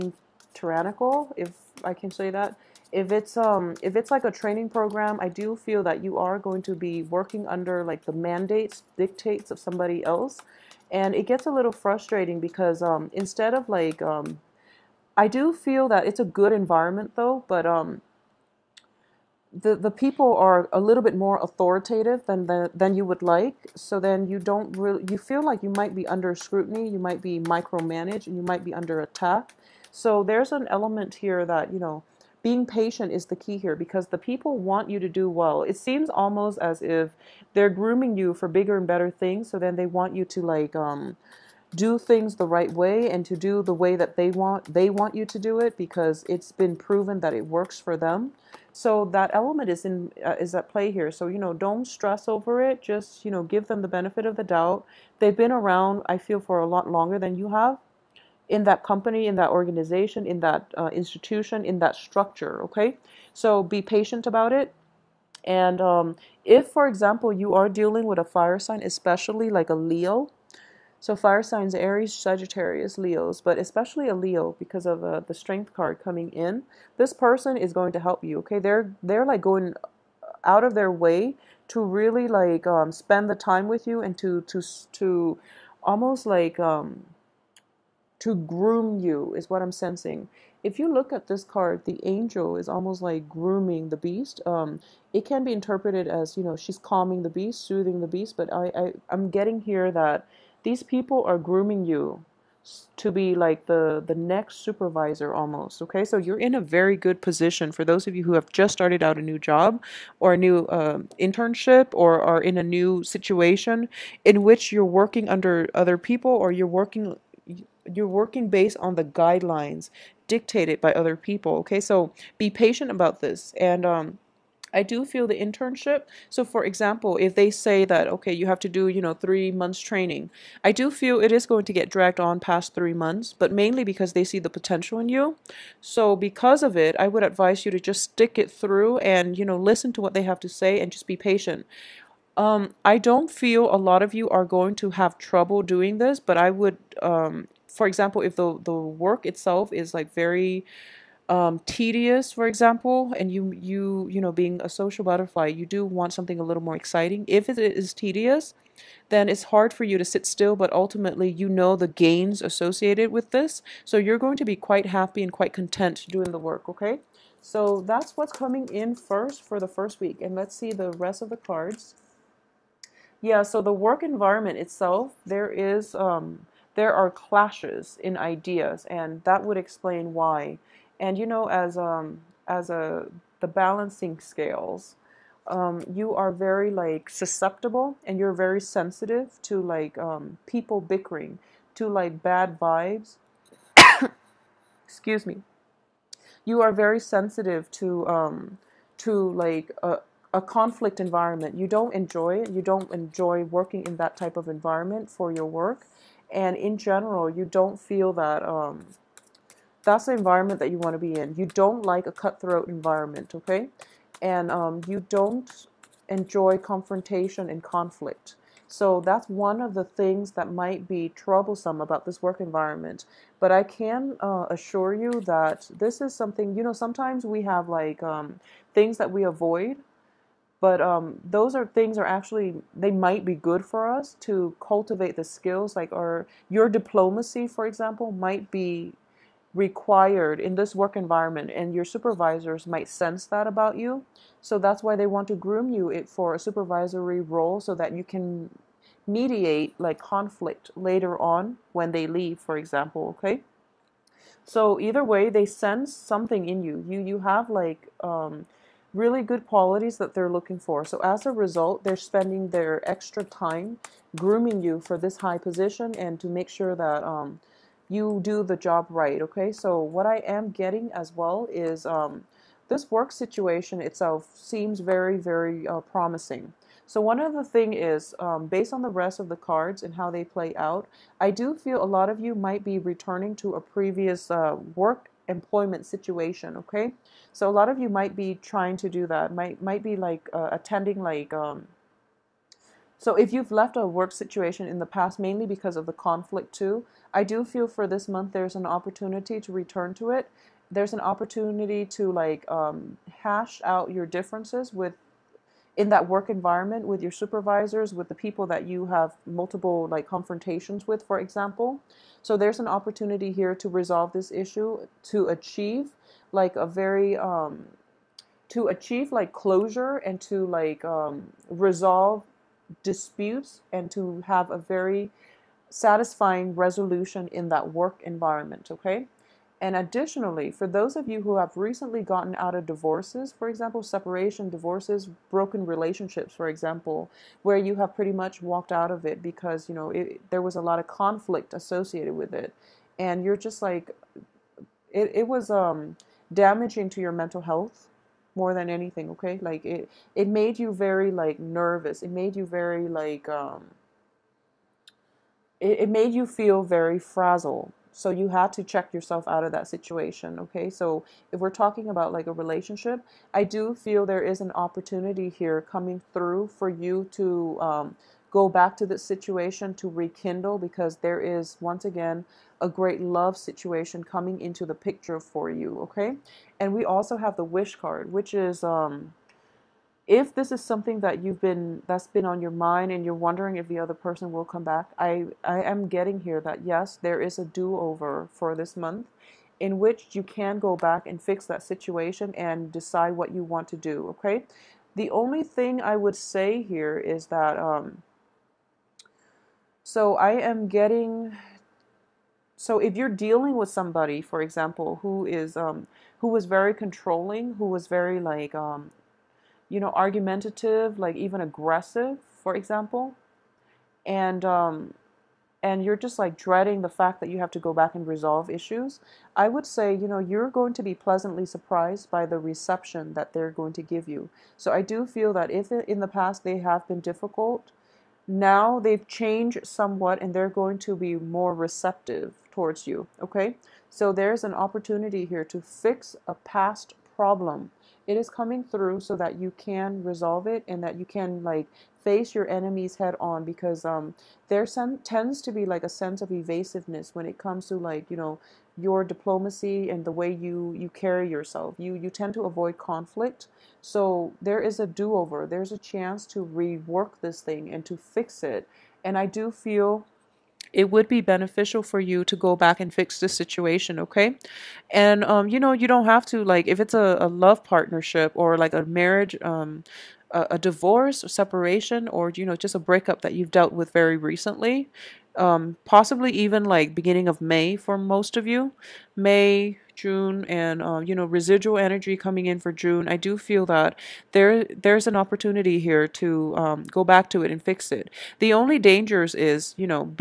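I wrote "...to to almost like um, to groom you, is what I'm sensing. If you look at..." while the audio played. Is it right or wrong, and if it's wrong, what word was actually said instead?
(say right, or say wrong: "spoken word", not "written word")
right.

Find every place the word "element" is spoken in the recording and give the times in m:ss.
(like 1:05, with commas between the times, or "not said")
0:30, 0:49.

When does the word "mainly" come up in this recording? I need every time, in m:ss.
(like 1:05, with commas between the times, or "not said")
2:13, 4:55.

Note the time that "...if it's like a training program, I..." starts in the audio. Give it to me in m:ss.
0:03.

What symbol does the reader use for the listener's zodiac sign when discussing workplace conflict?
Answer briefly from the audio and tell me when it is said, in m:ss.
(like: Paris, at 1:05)
balancing scales, at 3:03.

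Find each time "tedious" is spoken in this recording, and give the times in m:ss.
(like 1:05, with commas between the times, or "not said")
2:31, 2:37.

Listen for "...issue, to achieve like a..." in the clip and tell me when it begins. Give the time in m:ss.
5:14.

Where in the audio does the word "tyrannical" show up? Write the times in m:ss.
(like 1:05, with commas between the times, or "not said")
0:00.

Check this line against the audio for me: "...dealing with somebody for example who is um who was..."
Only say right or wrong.
right.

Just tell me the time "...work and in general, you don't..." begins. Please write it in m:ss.
3:25.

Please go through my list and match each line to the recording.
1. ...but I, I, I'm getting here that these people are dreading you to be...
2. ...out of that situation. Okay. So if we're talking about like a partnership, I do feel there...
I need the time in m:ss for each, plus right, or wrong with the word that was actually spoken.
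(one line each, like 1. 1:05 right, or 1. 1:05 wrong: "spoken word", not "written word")
1. 1:38 wrong: "grooming", not "dreading"
2. 5:59 wrong: "relationship", not "partnership".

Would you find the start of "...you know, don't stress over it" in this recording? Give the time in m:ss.
0:51.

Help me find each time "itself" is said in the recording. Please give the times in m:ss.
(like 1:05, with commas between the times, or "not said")
2:29, 2:54, 4:33.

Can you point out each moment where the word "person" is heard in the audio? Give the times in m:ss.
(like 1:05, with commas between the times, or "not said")
1:17, 6:23.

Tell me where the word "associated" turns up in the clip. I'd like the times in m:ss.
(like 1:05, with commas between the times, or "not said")
2:42, 5:41.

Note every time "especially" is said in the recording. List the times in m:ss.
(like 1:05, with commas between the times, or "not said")
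1:08, 1:13.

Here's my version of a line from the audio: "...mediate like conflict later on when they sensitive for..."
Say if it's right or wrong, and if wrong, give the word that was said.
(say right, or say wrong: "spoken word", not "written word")
wrong: "leave", not "sensitive".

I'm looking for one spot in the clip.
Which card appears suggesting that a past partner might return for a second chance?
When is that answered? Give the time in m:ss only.
6:17.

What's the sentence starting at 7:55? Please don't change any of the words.
Um, possibly even like beginning of May for most of you.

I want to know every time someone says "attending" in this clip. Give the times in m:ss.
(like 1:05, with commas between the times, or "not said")
4:50.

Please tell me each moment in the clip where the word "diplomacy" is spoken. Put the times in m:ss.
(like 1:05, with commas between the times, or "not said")
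3:56, 7:29.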